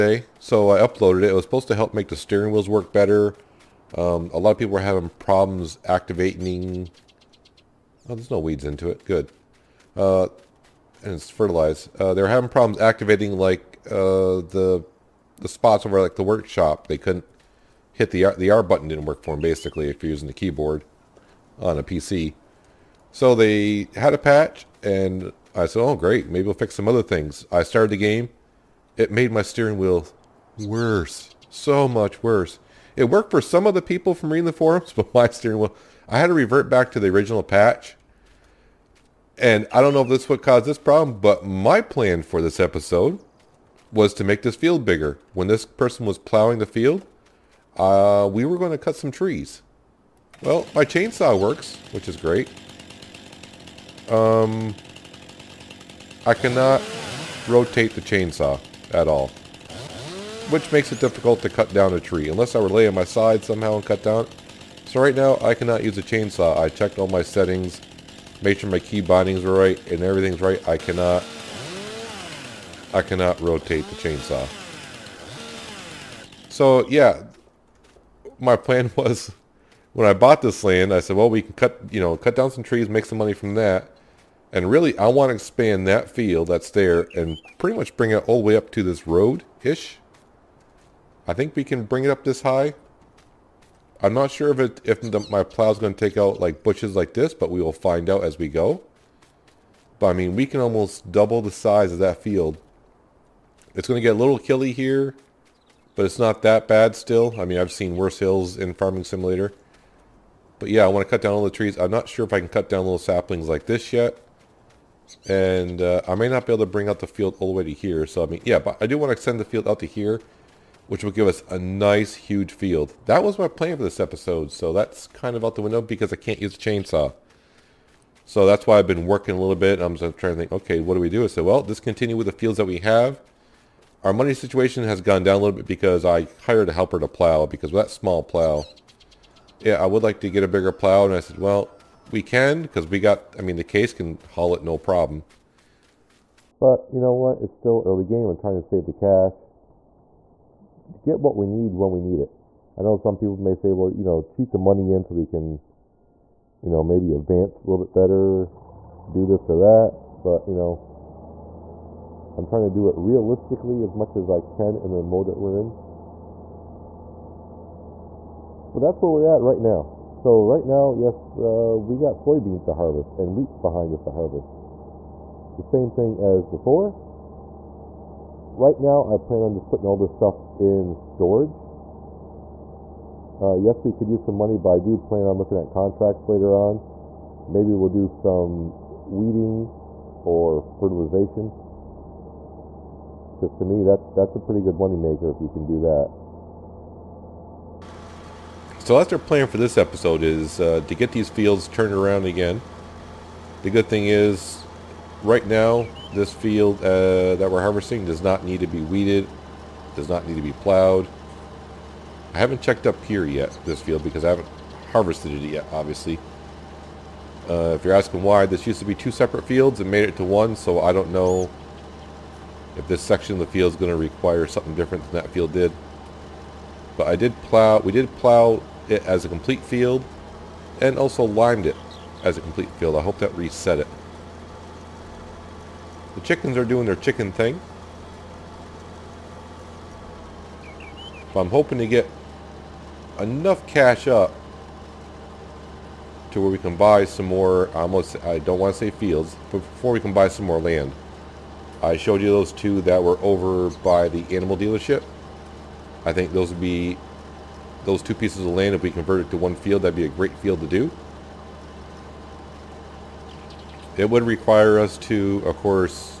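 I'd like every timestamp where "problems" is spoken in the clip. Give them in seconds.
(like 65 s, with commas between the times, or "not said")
5 s, 12 s, 40 s, 144 s.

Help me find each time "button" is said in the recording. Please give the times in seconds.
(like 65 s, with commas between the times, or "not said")
18 s.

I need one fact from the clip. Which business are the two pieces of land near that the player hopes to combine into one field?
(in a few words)
animal dealership.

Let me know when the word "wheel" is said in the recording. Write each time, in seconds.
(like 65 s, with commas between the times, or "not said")
2 s, 29 s, 35 s.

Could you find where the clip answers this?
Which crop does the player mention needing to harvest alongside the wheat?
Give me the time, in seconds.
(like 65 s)
172 s.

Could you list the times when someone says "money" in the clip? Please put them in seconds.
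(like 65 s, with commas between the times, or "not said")
83 s, 134 s, 154 s, 184 s, 194 s.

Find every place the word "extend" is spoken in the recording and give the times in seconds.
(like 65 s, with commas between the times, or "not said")
119 s.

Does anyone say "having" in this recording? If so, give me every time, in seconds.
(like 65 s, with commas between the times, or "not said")
4 s, 12 s.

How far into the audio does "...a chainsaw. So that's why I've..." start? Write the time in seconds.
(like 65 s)
126 s.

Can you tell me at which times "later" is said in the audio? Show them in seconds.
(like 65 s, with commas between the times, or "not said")
186 s.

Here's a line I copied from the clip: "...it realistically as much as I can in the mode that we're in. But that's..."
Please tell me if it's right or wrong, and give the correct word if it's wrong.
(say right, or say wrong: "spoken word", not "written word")
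right.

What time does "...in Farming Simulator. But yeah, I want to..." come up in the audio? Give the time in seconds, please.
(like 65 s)
108 s.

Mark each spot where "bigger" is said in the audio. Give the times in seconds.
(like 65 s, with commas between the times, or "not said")
44 s, 140 s.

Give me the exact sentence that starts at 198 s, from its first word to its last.
So that's our plan for this episode is uh, to get these fields turned around again.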